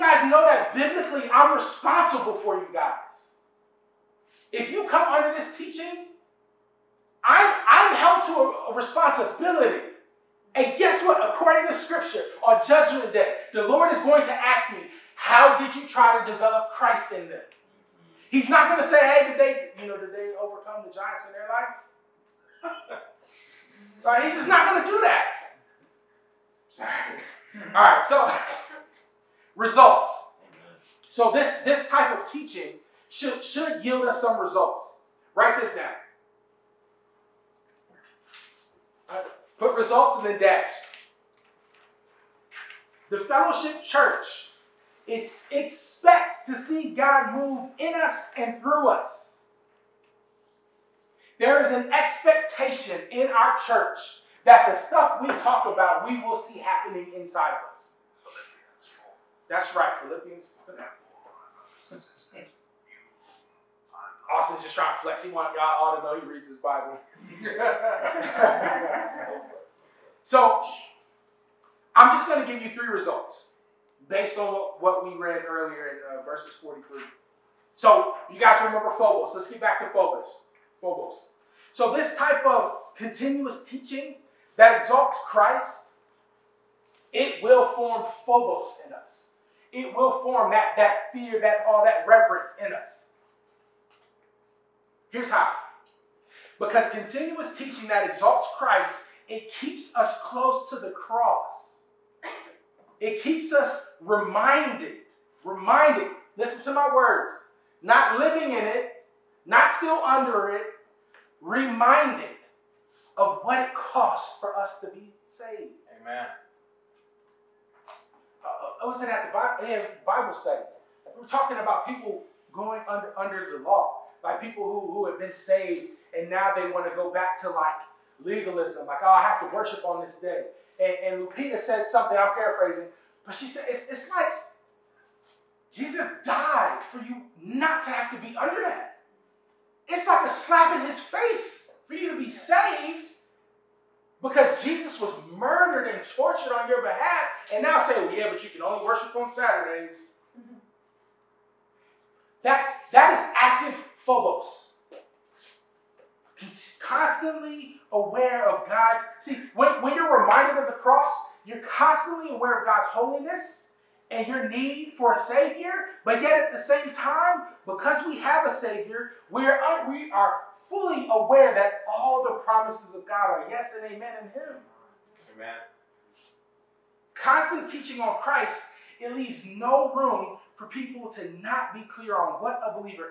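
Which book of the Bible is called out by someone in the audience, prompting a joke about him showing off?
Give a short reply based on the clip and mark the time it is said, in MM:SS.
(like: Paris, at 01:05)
Philippians, at 01:00.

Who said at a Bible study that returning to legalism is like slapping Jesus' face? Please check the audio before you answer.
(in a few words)
Lupita.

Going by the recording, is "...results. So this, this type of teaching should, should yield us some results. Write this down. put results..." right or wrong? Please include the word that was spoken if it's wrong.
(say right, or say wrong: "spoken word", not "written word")
right.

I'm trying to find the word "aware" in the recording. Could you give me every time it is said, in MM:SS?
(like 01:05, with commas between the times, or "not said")
02:37, 02:42, 02:51.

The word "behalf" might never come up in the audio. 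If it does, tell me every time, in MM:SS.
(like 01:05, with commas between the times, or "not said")
02:26.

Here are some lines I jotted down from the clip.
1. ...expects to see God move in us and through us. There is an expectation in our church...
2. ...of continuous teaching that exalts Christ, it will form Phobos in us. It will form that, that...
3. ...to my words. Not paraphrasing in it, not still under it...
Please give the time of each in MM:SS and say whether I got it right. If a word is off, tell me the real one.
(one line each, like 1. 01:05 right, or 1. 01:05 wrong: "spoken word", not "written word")
1. 00:45 right
2. 01:22 right
3. 01:46 wrong: "living", not "paraphrasing".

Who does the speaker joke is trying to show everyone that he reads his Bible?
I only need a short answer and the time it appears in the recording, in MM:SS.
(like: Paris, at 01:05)
Austin, at 01:04.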